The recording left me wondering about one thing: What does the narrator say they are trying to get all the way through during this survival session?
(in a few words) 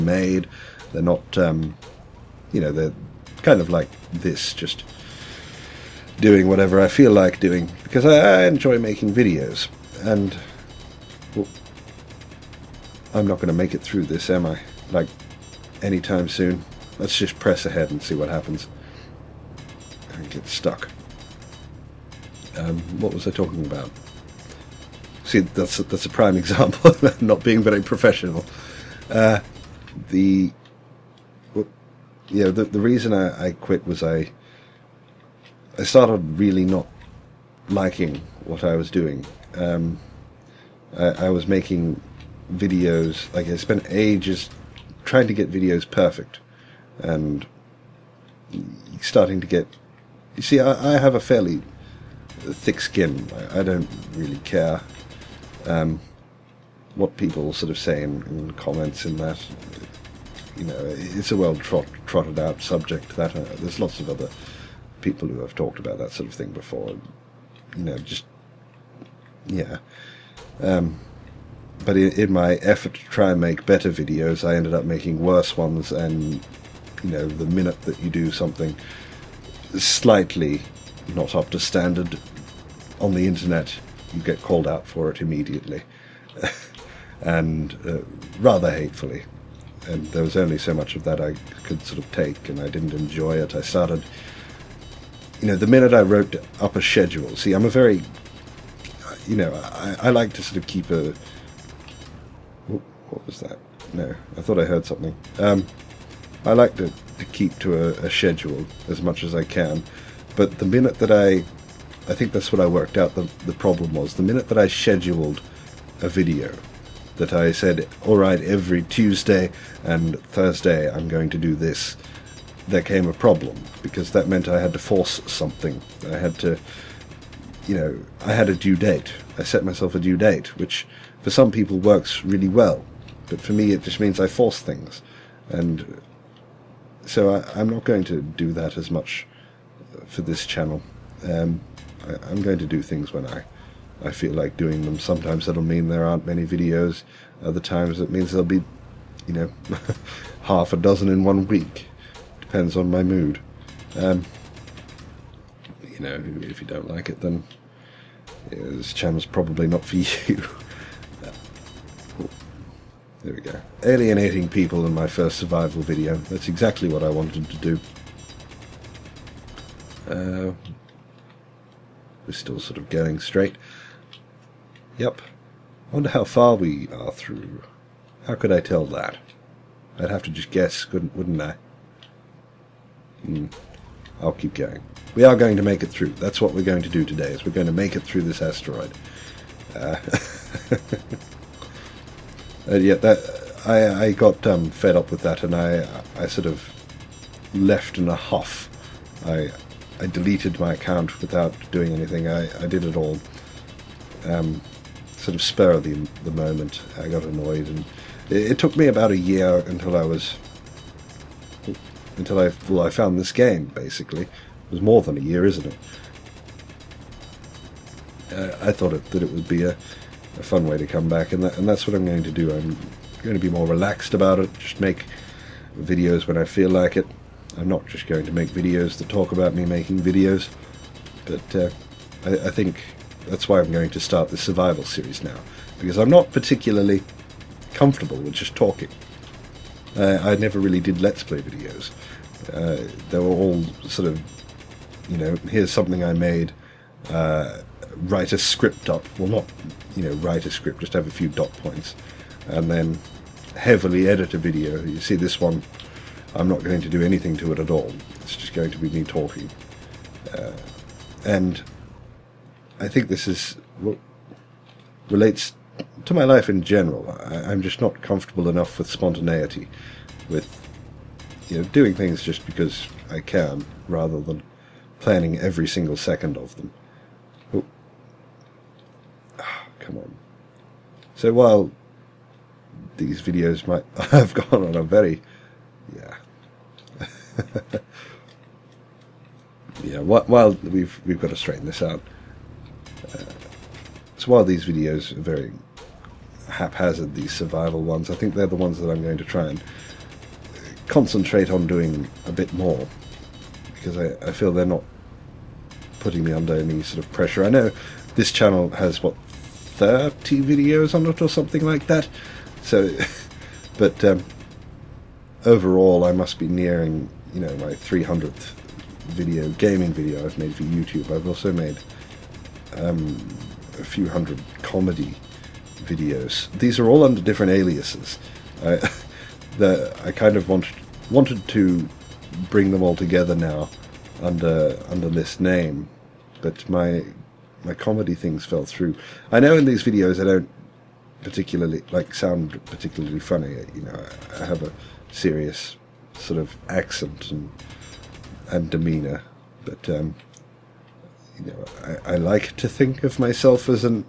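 asteroid.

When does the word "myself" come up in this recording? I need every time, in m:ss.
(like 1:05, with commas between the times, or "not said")
2:09, 5:53.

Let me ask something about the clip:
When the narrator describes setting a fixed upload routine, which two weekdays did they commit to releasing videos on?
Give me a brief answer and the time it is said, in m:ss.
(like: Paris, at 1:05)
Tuesday and Thursday, at 1:58.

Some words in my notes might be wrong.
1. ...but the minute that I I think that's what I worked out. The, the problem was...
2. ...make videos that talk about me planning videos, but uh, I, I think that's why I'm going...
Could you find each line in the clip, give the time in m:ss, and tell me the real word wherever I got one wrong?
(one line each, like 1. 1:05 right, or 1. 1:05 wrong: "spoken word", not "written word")
1. 1:50 right
2. 3:48 wrong: "making", not "planning".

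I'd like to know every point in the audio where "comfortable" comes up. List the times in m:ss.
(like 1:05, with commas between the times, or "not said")
3:57, 4:27.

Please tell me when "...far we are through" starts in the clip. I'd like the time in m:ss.
2:56.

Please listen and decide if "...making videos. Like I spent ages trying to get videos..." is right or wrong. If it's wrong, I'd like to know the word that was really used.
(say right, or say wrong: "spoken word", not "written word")
right.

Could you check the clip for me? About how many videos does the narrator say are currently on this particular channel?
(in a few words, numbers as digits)
30.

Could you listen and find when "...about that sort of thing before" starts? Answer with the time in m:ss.
1:05.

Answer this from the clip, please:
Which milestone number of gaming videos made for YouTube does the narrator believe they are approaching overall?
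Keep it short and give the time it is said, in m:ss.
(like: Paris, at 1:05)
300th, at 5:17.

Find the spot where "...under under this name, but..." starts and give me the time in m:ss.
5:34.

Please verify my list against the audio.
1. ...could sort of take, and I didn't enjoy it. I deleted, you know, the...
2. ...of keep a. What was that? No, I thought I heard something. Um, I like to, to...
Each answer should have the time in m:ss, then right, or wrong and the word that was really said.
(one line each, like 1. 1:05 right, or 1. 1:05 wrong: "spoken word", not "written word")
1. 1:31 wrong: "started", not "deleted"
2. 1:40 right.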